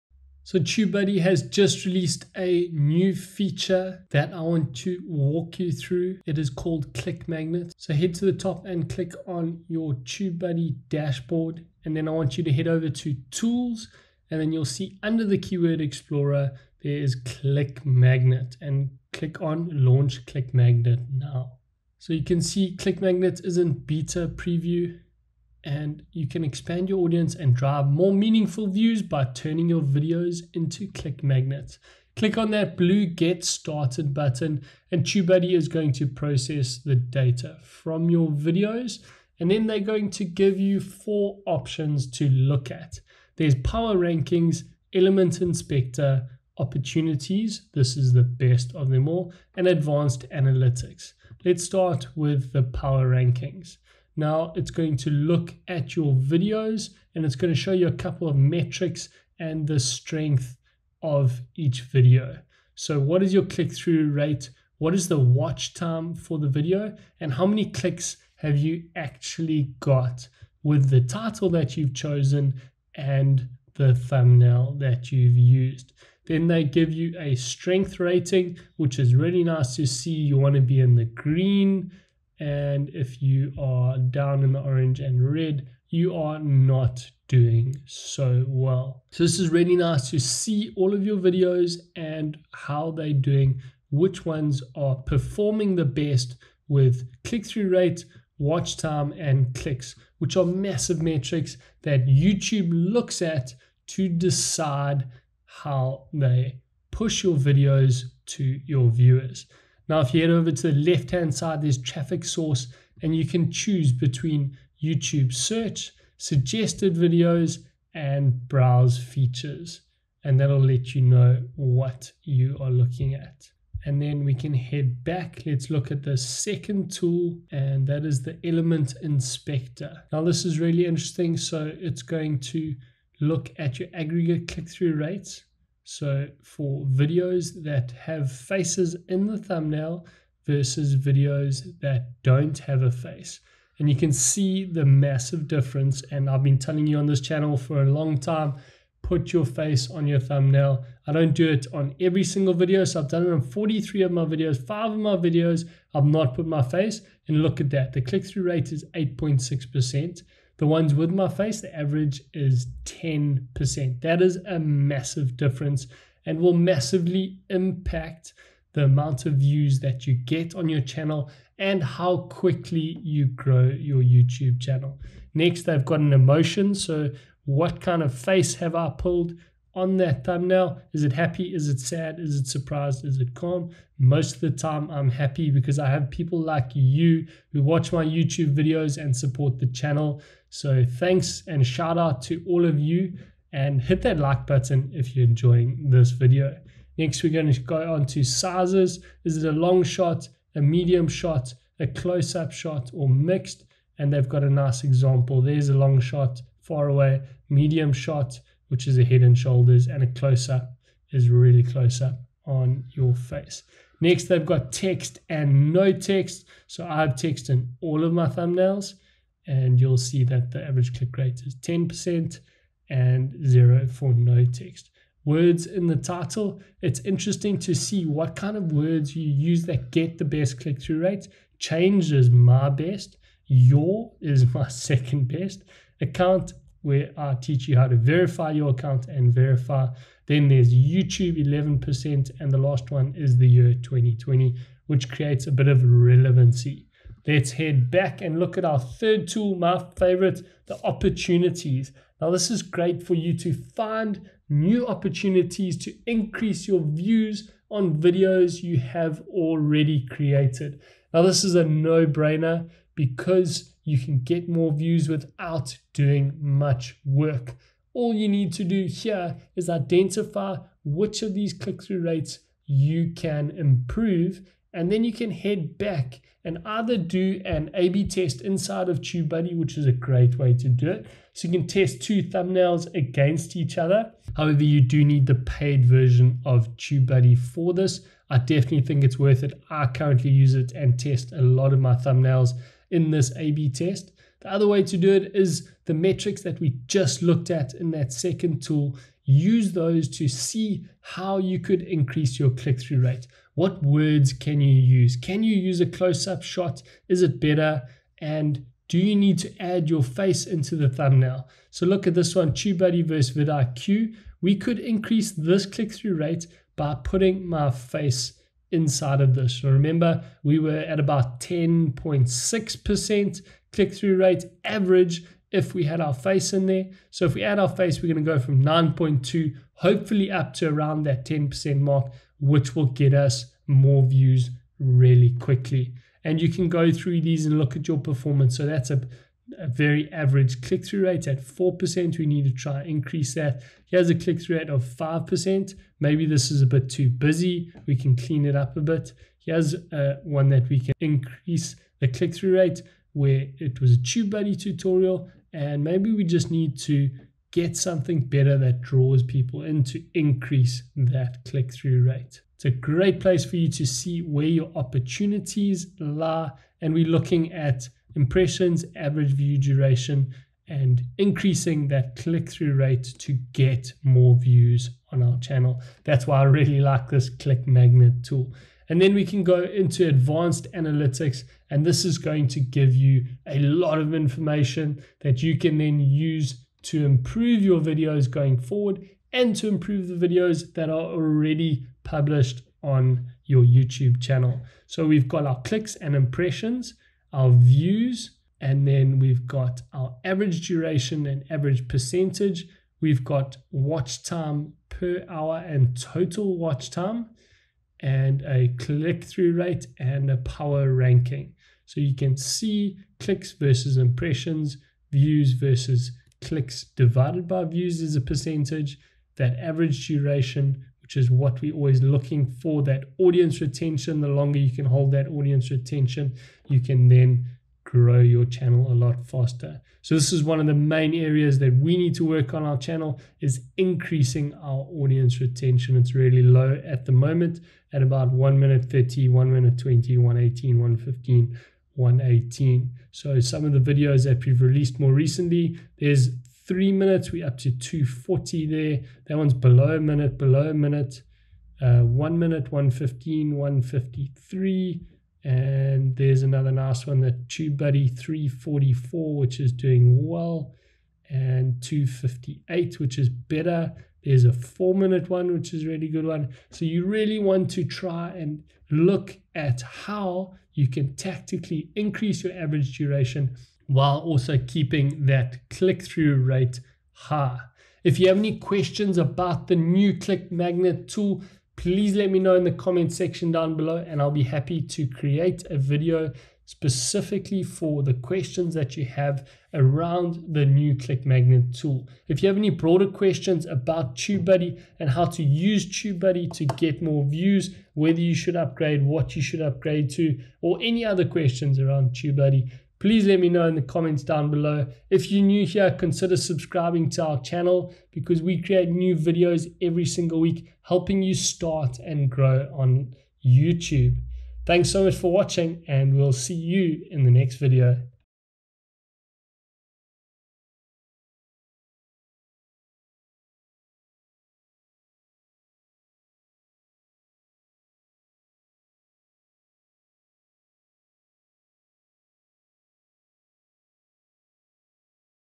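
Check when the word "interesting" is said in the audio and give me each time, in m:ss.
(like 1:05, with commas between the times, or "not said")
2:10, 3:47.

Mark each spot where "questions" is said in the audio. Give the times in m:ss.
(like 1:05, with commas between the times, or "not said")
7:58, 8:08, 8:13, 8:21.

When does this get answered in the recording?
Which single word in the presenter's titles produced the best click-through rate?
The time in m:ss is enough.
3:51.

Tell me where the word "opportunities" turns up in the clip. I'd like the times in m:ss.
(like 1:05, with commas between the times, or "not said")
0:46, 4:10, 4:14, 6:04.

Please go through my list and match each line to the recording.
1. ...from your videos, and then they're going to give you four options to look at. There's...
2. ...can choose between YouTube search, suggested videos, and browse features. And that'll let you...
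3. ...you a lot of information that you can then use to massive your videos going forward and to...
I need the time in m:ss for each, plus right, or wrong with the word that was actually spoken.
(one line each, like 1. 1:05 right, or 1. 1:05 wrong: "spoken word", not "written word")
1. 0:37 right
2. 1:53 right
3. 6:22 wrong: "improve", not "massive".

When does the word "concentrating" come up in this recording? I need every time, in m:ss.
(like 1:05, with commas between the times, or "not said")
not said.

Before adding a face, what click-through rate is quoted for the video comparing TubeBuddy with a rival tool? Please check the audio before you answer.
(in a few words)
9.2.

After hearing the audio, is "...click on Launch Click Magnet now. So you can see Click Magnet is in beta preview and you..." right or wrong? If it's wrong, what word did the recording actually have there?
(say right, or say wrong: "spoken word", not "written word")
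right.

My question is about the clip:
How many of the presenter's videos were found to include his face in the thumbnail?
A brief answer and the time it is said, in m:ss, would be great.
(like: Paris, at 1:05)
43, at 2:33.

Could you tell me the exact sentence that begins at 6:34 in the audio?
So we've got our clicks and impressions, our views, and then we've got our average duration and average percentage.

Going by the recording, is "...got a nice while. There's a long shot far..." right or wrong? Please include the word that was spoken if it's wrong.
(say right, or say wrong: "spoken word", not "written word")
wrong: "example", not "while".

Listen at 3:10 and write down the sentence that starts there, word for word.
So thanks and shout out to all of you and hit that like button if you're enjoying this video.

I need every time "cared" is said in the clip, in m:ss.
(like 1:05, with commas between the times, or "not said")
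not said.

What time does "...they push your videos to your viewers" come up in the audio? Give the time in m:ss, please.
1:46.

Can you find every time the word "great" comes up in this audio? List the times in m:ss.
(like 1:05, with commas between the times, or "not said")
4:12, 4:39, 6:02.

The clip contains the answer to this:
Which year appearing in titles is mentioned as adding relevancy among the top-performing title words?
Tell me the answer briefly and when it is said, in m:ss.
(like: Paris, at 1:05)
2020, at 4:03.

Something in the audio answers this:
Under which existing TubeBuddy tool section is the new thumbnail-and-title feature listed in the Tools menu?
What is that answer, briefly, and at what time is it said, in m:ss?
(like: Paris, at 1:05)
Keyword Explorer, at 0:15.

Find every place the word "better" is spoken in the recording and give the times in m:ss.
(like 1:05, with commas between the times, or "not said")
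5:07, 5:58, 7:43.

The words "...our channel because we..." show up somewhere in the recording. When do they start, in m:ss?
8:27.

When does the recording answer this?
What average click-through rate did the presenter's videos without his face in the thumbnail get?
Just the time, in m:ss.
2:38.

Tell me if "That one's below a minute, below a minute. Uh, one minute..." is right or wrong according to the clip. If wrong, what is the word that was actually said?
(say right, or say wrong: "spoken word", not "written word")
right.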